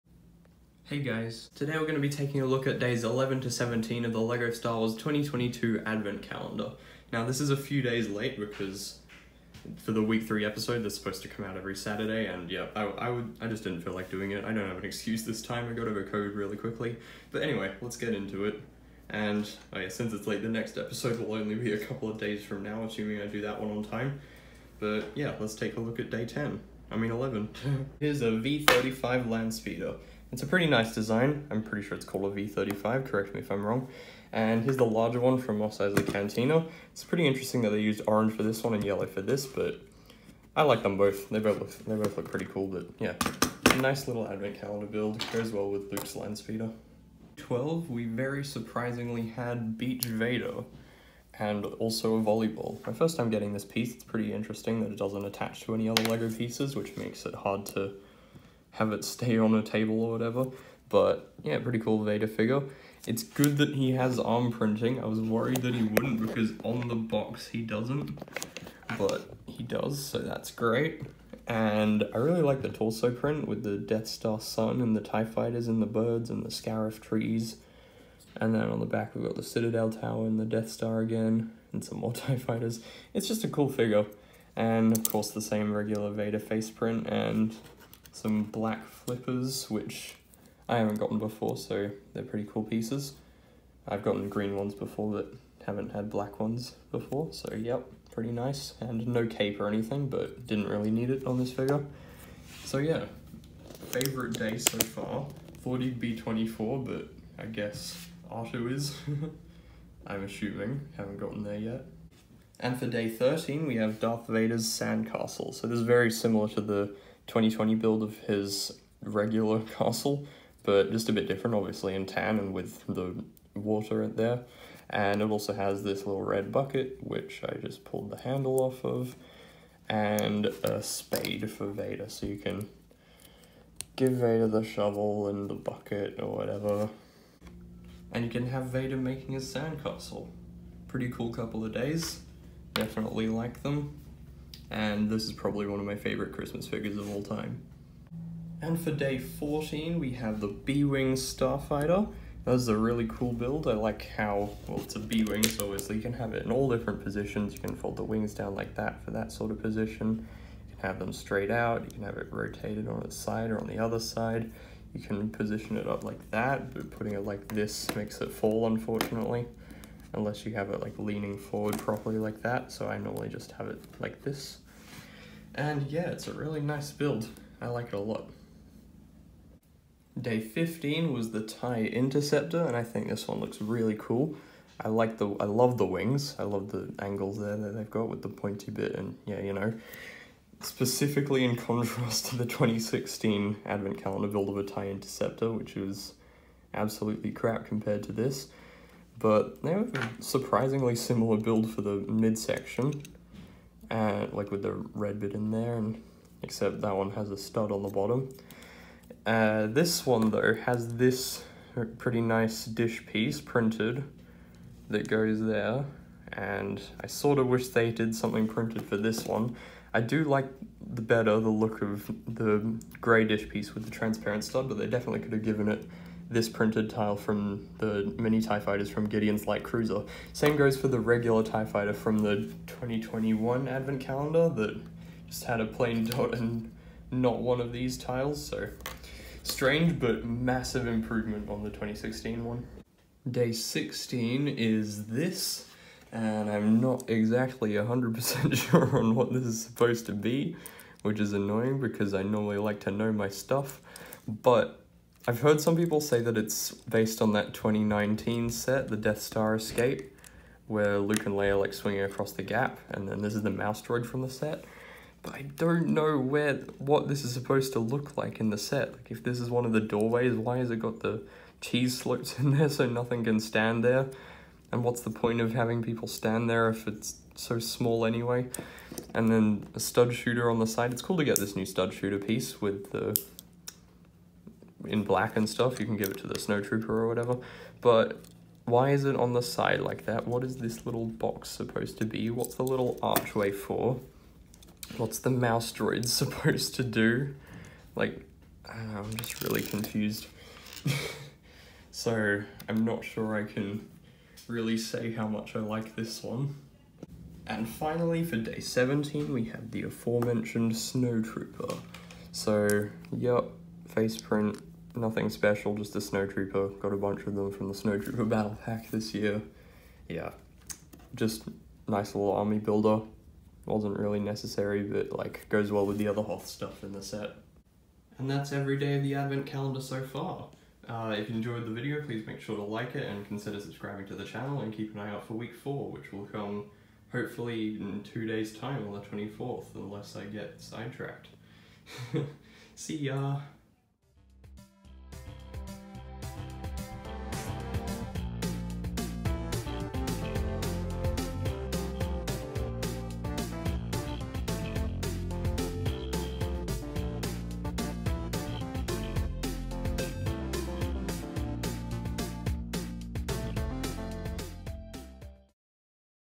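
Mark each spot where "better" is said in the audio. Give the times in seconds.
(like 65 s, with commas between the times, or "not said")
221 s.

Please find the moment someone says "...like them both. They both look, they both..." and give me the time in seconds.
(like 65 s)
40 s.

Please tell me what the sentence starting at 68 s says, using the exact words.
But he does, so that's great.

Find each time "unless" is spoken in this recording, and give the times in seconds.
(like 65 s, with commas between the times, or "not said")
170 s, 339 s.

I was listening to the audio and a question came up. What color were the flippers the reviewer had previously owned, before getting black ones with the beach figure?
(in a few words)
green.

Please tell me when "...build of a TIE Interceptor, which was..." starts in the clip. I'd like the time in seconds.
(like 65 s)
194 s.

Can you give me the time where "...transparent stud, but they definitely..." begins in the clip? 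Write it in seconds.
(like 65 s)
223 s.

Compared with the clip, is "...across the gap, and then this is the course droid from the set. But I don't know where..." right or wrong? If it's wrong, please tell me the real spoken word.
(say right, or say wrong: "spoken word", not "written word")
wrong: "mouse", not "course".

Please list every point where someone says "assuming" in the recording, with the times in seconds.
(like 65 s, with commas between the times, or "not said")
22 s, 110 s.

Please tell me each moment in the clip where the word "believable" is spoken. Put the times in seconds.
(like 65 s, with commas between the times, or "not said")
not said.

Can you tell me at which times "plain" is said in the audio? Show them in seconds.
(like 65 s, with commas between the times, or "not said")
235 s.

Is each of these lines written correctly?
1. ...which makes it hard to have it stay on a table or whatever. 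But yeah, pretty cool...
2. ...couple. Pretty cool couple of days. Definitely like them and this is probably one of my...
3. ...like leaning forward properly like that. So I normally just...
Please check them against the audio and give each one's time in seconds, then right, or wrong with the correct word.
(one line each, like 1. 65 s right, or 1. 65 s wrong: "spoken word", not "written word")
1. 56 s right
2. 139 s wrong: "sandcastle", not "couple"
3. 170 s right.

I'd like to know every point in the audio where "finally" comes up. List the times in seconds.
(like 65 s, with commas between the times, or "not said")
307 s.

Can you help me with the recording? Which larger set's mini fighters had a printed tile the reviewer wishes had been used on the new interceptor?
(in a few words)
Gideon's Light Cruiser.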